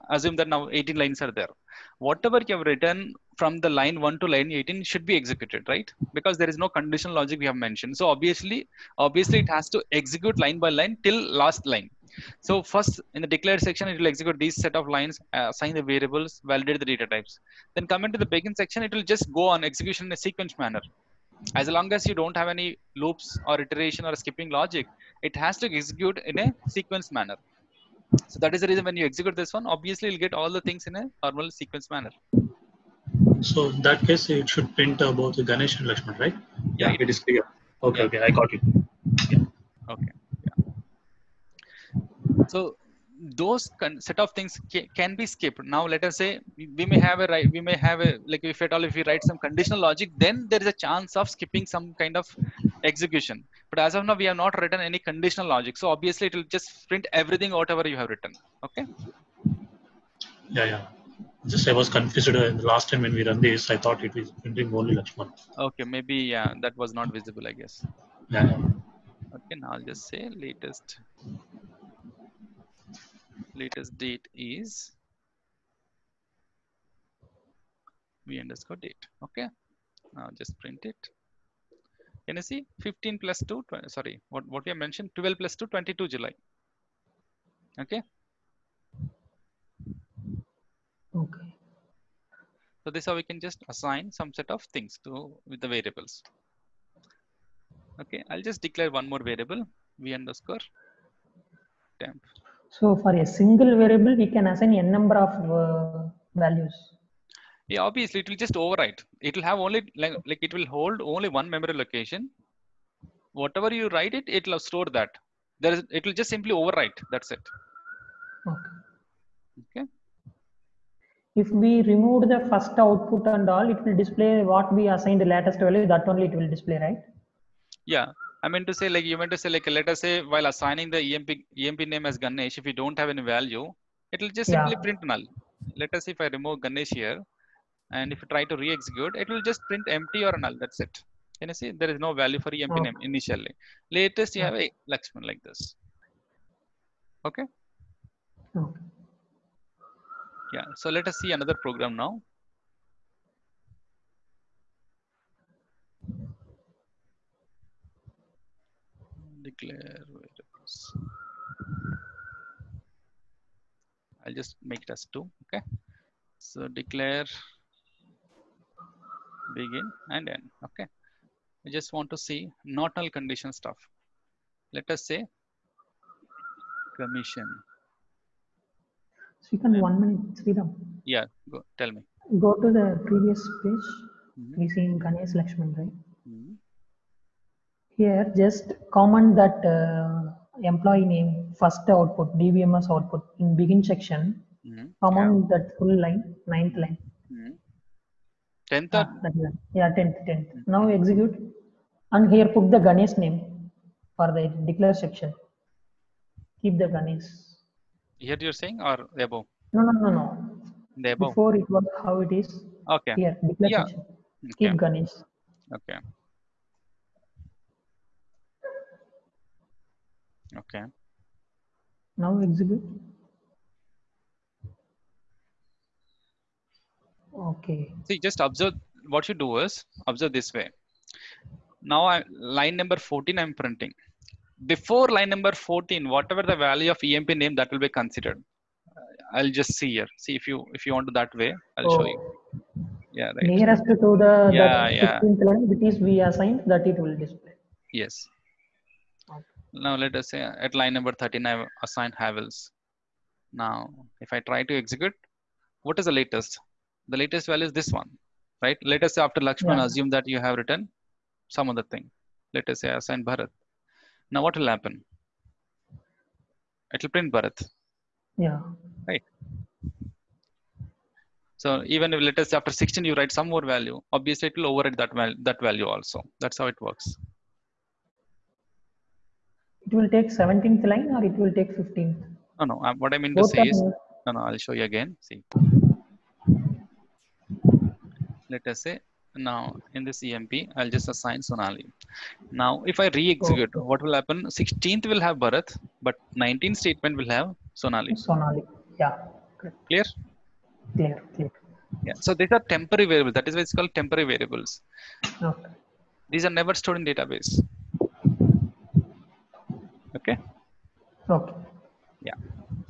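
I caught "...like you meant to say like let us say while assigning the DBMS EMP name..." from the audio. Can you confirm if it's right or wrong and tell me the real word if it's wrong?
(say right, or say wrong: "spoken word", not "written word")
wrong: "EMP", not "DBMS".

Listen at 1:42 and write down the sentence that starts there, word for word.
So for a single variable, we can assign n number of uh, values.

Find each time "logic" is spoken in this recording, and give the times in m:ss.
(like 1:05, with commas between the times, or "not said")
0:07, 0:24, 0:49, 0:55.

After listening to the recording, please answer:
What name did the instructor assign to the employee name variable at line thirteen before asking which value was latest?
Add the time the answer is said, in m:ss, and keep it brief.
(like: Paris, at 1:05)
Havels, at 4:12.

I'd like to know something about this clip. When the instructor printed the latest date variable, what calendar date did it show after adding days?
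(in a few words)
22 July.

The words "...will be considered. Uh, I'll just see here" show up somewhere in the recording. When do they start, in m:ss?
3:57.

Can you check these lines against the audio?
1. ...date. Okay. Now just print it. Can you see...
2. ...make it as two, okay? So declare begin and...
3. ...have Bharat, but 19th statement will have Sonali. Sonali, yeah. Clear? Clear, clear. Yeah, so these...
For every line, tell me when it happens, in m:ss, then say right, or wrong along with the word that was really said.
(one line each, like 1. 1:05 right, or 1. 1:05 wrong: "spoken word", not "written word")
1. 1:18 right
2. 2:44 right
3. 4:55 right.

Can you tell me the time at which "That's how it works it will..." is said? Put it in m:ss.
4:36.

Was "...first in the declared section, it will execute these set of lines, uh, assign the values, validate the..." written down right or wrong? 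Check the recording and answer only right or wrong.
wrong.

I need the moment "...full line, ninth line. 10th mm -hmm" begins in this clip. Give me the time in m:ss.
3:15.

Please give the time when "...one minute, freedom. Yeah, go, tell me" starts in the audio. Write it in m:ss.
2:59.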